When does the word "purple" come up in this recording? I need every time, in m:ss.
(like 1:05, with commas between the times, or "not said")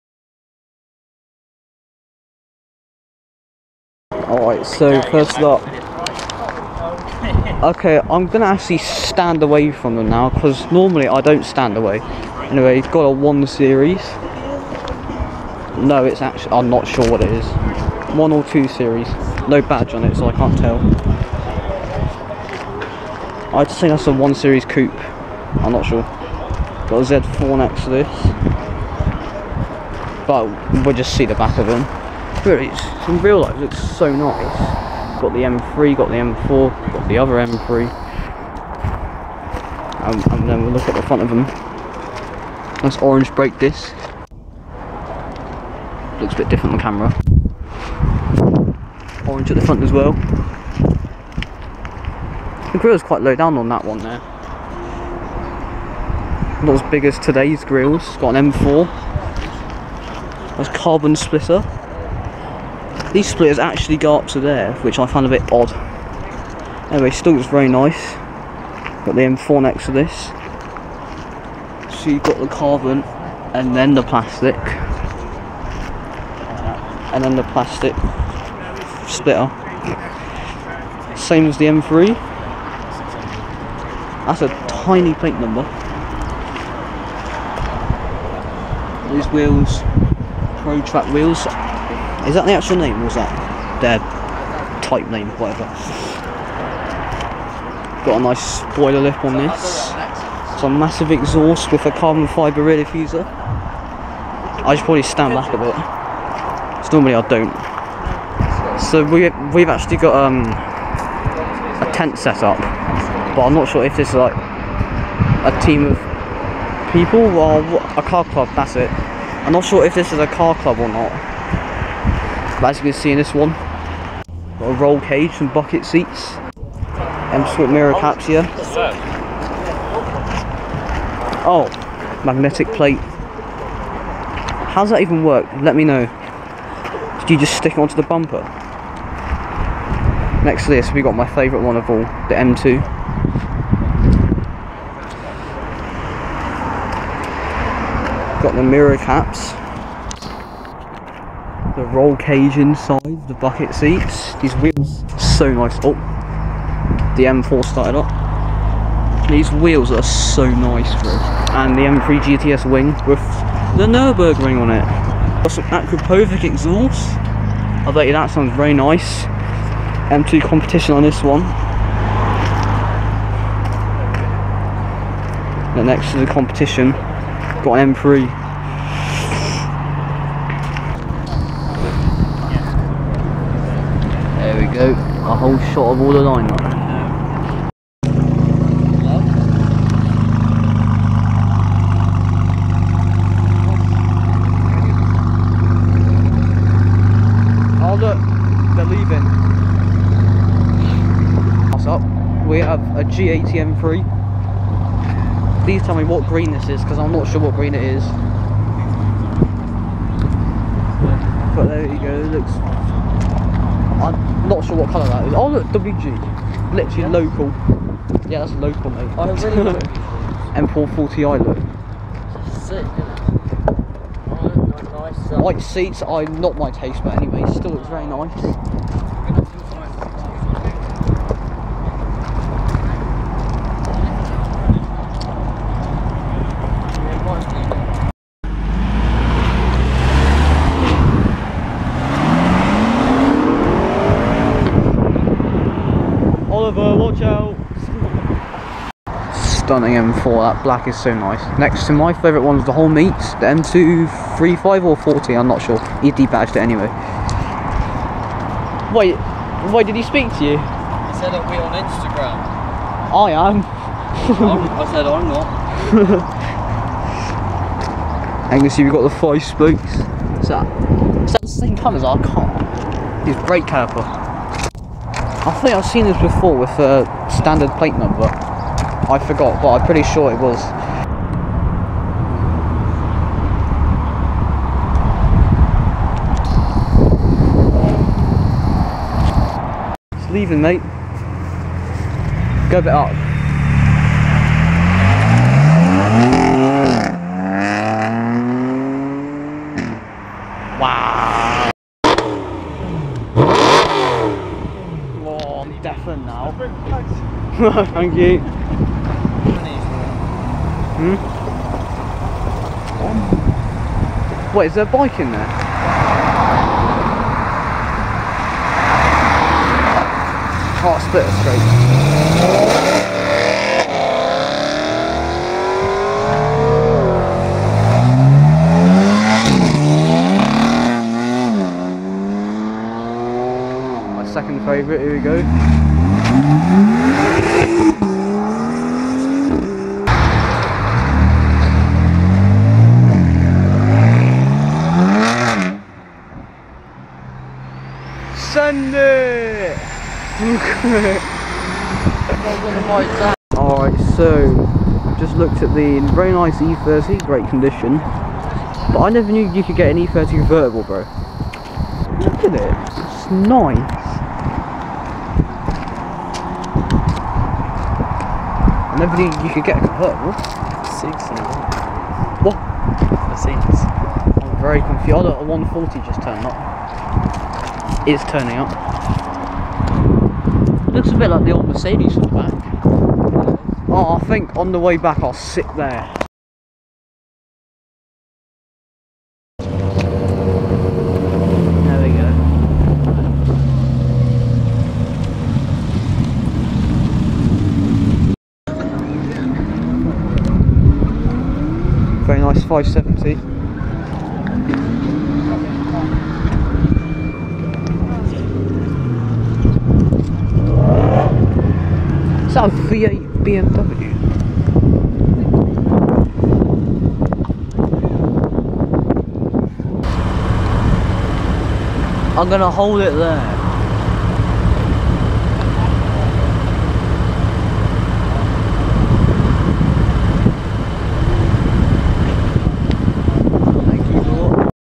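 not said.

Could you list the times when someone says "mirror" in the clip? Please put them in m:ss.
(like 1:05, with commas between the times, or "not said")
2:07, 2:28.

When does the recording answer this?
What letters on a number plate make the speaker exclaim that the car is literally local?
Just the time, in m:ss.
3:35.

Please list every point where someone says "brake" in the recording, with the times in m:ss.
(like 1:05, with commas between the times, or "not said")
0:43, 4:33.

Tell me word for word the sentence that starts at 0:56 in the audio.
Not as big as today's grills.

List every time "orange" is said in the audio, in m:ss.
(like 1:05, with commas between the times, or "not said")
0:42, 0:49.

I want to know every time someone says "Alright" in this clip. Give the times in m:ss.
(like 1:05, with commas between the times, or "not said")
0:04, 5:53.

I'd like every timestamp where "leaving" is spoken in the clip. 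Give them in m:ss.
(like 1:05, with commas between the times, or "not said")
3:18, 4:50.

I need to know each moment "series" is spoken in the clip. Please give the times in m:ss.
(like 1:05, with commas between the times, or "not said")
0:13, 0:18, 0:24.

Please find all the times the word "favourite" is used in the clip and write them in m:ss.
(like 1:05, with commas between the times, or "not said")
2:21, 4:12, 5:34.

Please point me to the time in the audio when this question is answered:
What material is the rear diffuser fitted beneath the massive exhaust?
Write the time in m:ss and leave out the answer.
1:41.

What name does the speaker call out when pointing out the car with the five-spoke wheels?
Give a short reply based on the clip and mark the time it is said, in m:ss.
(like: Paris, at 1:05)
Angus, at 4:28.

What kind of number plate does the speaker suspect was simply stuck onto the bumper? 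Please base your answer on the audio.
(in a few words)
Magnetic plate.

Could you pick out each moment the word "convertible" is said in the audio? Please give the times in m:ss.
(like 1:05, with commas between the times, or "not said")
6:00, 6:09.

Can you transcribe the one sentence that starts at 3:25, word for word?
Please tell me what green this is, because I'm not sure what green it is.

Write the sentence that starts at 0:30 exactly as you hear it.
But we'll just see the back of them.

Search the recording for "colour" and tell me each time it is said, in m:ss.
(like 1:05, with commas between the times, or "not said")
3:34, 4:31.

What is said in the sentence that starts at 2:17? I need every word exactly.
Did you just stick it onto the bumper?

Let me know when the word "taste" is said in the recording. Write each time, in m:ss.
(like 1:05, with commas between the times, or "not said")
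3:46.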